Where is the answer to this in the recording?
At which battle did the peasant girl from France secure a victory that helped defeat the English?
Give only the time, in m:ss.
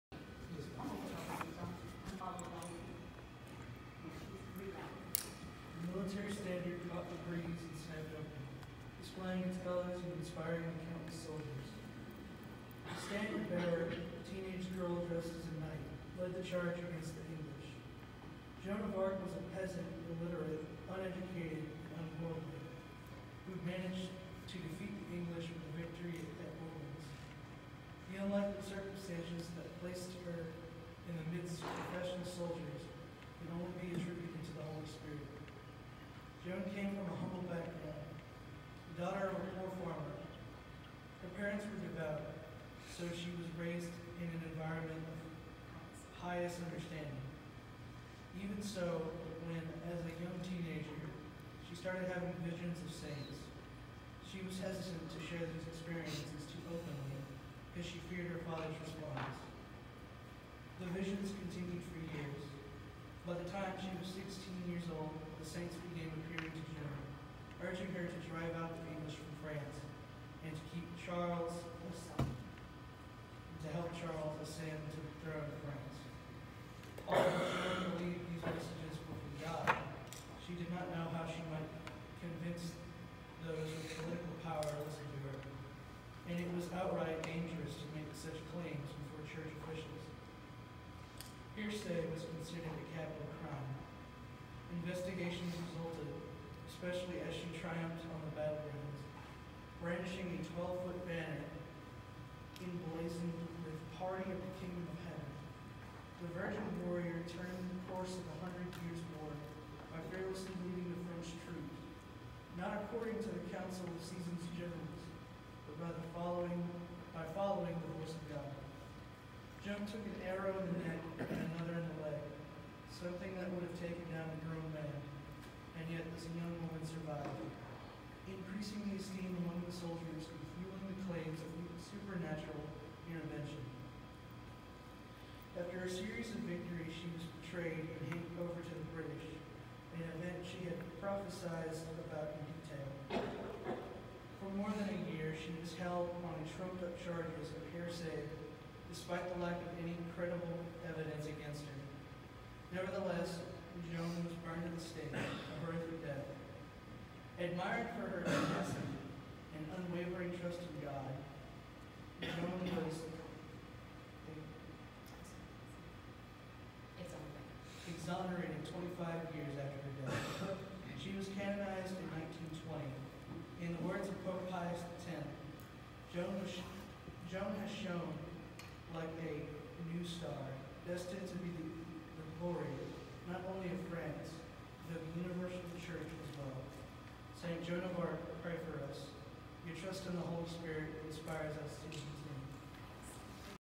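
0:26.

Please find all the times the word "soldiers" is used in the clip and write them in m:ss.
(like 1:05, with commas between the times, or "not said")
0:11, 0:32, 2:09.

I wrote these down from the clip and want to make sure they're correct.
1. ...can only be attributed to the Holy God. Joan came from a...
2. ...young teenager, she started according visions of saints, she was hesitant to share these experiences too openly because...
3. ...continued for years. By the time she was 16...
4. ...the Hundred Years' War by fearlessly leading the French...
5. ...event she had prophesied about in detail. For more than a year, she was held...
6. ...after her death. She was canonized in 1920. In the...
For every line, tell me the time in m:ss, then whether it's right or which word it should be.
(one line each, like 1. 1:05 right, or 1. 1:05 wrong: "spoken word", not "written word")
1. 0:33 wrong: "Spirit", not "God"
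2. 0:50 wrong: "having", not "according"
3. 1:01 right
4. 1:48 right
5. 2:20 right
6. 2:49 right.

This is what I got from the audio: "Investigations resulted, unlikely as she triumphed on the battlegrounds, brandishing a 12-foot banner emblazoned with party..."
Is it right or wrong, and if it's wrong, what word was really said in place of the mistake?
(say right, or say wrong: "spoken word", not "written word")
wrong: "especially", not "unlikely".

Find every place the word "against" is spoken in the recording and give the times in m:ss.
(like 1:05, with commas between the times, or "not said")
0:16, 2:31.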